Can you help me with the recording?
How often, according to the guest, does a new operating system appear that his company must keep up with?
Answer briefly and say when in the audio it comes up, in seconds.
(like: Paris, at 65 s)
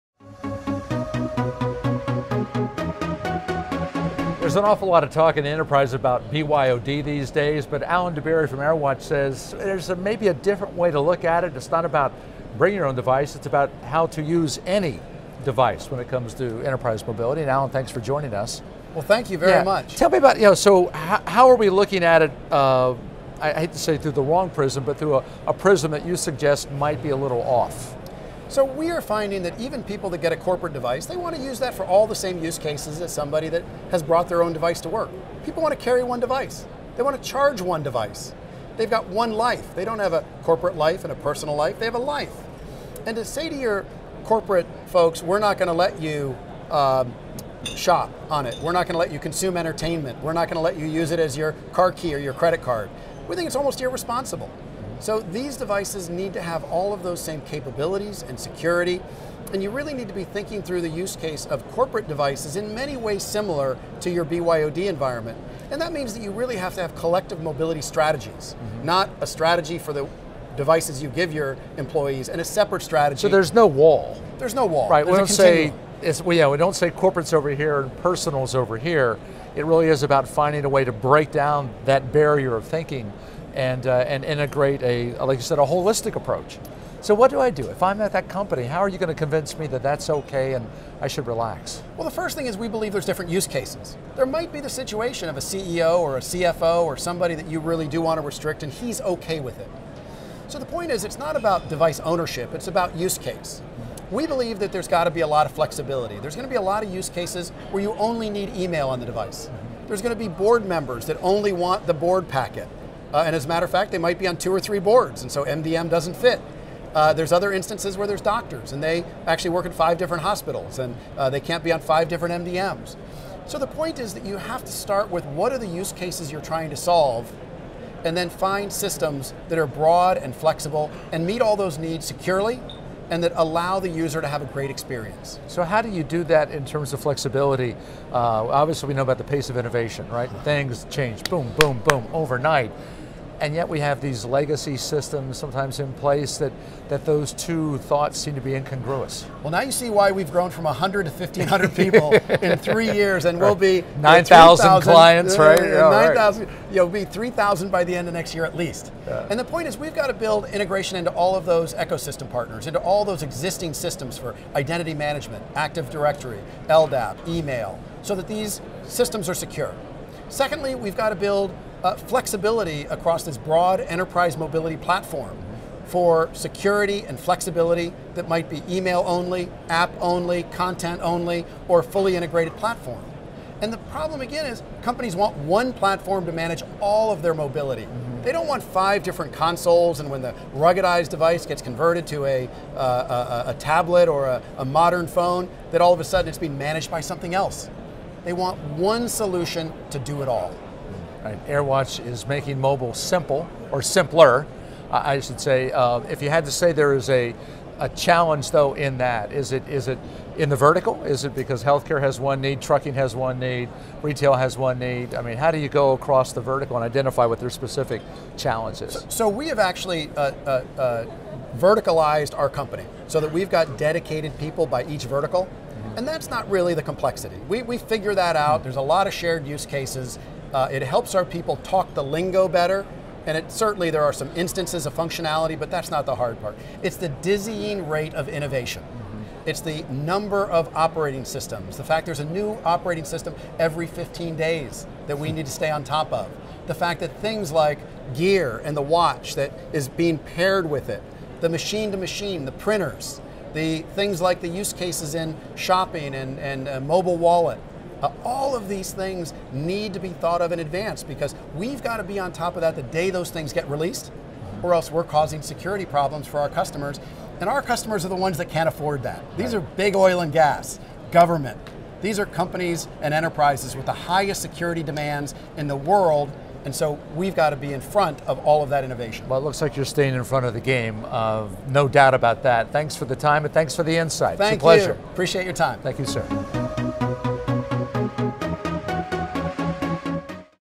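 every 15 days, at 243 s.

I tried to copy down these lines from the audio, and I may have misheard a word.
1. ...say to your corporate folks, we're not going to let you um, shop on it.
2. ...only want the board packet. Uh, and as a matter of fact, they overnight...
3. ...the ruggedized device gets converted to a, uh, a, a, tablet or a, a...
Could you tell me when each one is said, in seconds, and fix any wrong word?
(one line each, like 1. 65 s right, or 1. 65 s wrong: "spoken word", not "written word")
1. 43 s right
2. 111 s wrong: "might", not "overnight"
3. 190 s right.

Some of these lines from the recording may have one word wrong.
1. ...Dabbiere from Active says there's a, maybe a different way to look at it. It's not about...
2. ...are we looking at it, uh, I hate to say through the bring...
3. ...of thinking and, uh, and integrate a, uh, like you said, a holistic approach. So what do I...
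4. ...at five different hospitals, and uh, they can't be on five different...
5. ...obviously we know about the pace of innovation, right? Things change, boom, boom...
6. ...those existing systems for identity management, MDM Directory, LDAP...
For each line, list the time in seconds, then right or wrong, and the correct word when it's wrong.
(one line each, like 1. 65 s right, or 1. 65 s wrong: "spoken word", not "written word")
1. 8 s wrong: "AirWatch", not "Active"
2. 21 s wrong: "wrong", not "bring"
3. 82 s right
4. 119 s right
5. 138 s right
6. 163 s wrong: "Active", not "MDM".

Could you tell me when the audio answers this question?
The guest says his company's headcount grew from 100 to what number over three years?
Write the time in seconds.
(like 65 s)
151 s.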